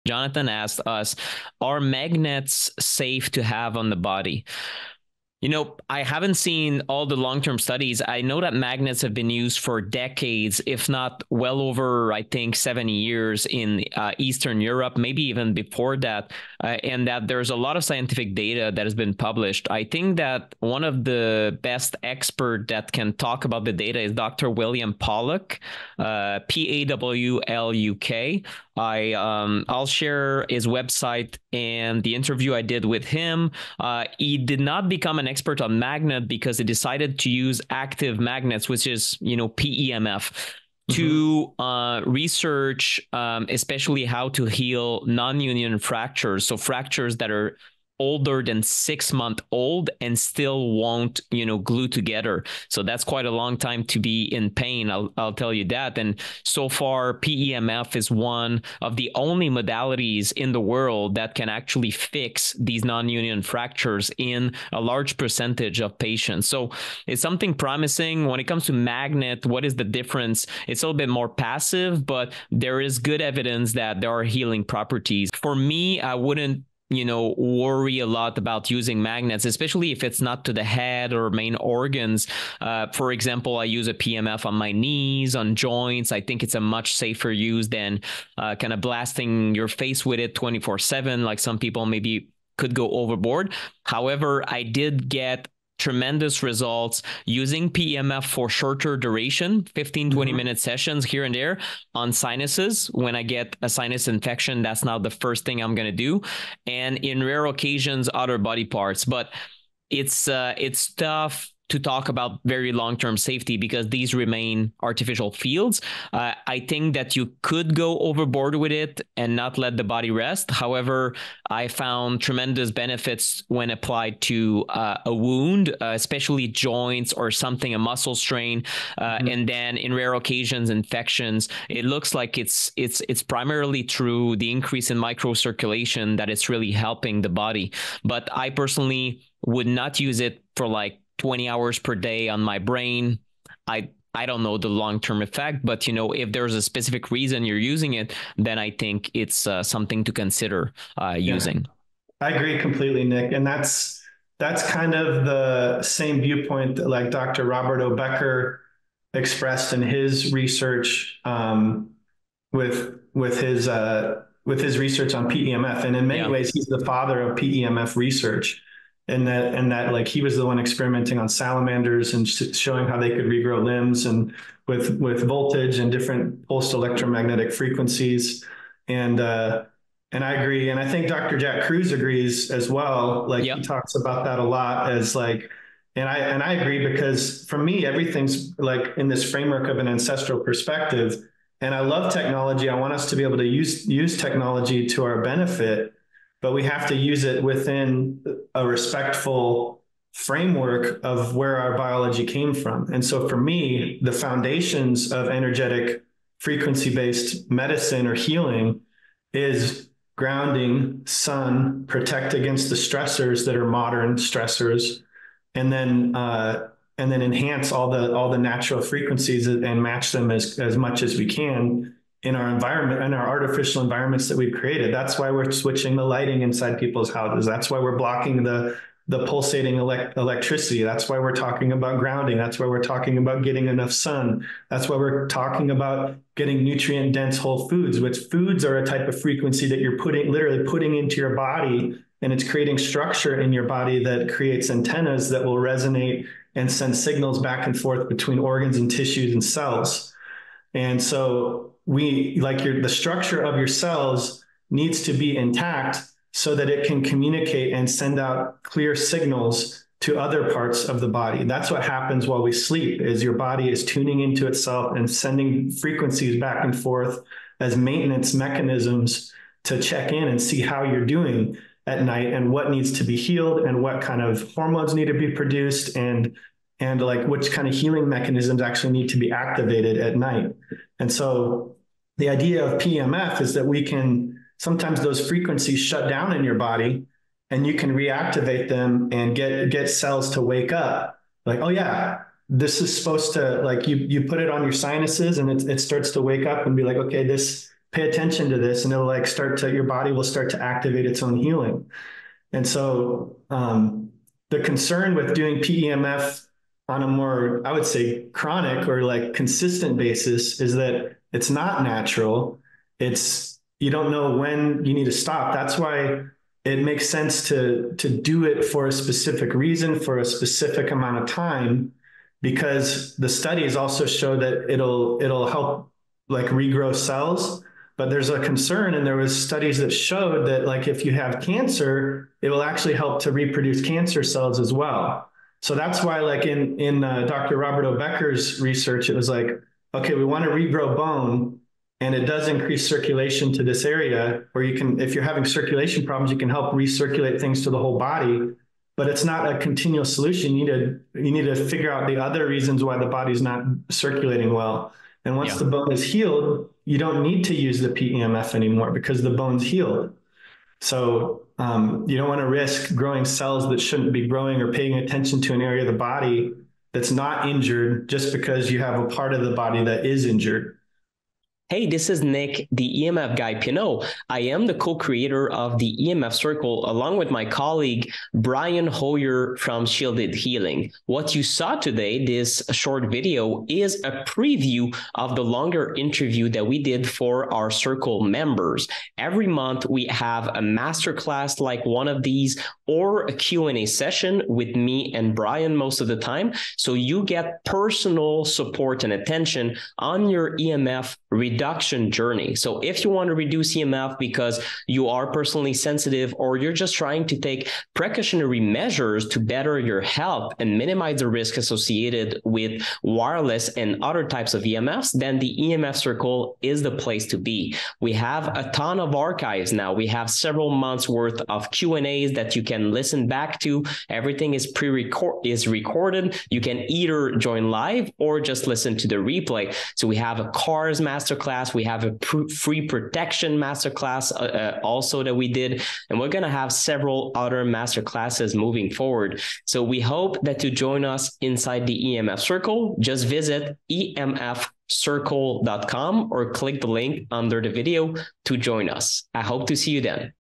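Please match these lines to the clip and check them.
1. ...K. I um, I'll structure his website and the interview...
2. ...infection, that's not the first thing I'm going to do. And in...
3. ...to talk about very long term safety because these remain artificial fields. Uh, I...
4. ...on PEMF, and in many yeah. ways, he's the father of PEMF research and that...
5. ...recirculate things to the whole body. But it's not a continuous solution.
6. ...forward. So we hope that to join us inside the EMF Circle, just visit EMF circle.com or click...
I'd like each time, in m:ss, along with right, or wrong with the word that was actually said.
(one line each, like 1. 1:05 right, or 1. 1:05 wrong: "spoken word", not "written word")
1. 0:27 wrong: "share", not "structure"
2. 1:44 right
3. 1:51 right
4. 2:45 right
5. 5:46 right
6. 7:18 right.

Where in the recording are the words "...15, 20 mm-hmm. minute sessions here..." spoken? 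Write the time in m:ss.
1:39.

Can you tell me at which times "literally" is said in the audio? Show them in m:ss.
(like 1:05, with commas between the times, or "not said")
4:00.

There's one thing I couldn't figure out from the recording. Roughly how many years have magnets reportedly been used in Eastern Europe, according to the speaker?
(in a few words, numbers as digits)
70.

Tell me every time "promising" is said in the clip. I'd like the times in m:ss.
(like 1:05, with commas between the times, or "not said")
1:07.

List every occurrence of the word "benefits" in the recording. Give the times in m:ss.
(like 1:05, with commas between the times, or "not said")
2:02, 3:15.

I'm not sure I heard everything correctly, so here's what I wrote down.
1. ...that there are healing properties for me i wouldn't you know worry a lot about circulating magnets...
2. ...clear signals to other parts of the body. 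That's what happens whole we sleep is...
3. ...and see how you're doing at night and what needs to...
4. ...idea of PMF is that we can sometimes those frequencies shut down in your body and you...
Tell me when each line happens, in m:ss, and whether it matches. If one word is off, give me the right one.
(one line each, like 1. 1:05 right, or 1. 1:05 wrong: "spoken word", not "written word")
1. 1:13 wrong: "using", not "circulating"
2. 4:18 wrong: "while", not "whole"
3. 4:30 right
4. 4:42 right.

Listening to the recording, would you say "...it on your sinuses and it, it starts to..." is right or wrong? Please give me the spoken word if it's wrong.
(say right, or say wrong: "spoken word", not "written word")
right.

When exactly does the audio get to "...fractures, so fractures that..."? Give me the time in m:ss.
0:45.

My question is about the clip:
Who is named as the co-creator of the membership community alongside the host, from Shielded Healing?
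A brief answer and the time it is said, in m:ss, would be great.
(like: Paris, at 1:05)
Brian Hoyer, at 6:18.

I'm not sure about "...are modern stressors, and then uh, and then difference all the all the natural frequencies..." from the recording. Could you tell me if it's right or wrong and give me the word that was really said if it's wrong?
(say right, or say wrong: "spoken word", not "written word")
wrong: "enhance", not "difference".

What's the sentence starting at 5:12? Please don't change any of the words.
It's you don't know when you need to stop.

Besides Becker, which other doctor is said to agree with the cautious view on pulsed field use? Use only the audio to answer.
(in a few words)
Jack Kruse.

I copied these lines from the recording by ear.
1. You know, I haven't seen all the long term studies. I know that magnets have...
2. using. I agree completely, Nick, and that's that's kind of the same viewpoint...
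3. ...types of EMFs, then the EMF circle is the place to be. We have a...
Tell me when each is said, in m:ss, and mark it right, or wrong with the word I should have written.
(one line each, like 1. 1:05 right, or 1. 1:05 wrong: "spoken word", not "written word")
1. 0:05 right
2. 2:31 right
3. 6:54 right.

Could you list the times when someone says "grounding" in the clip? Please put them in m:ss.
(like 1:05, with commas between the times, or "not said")
3:30, 3:51.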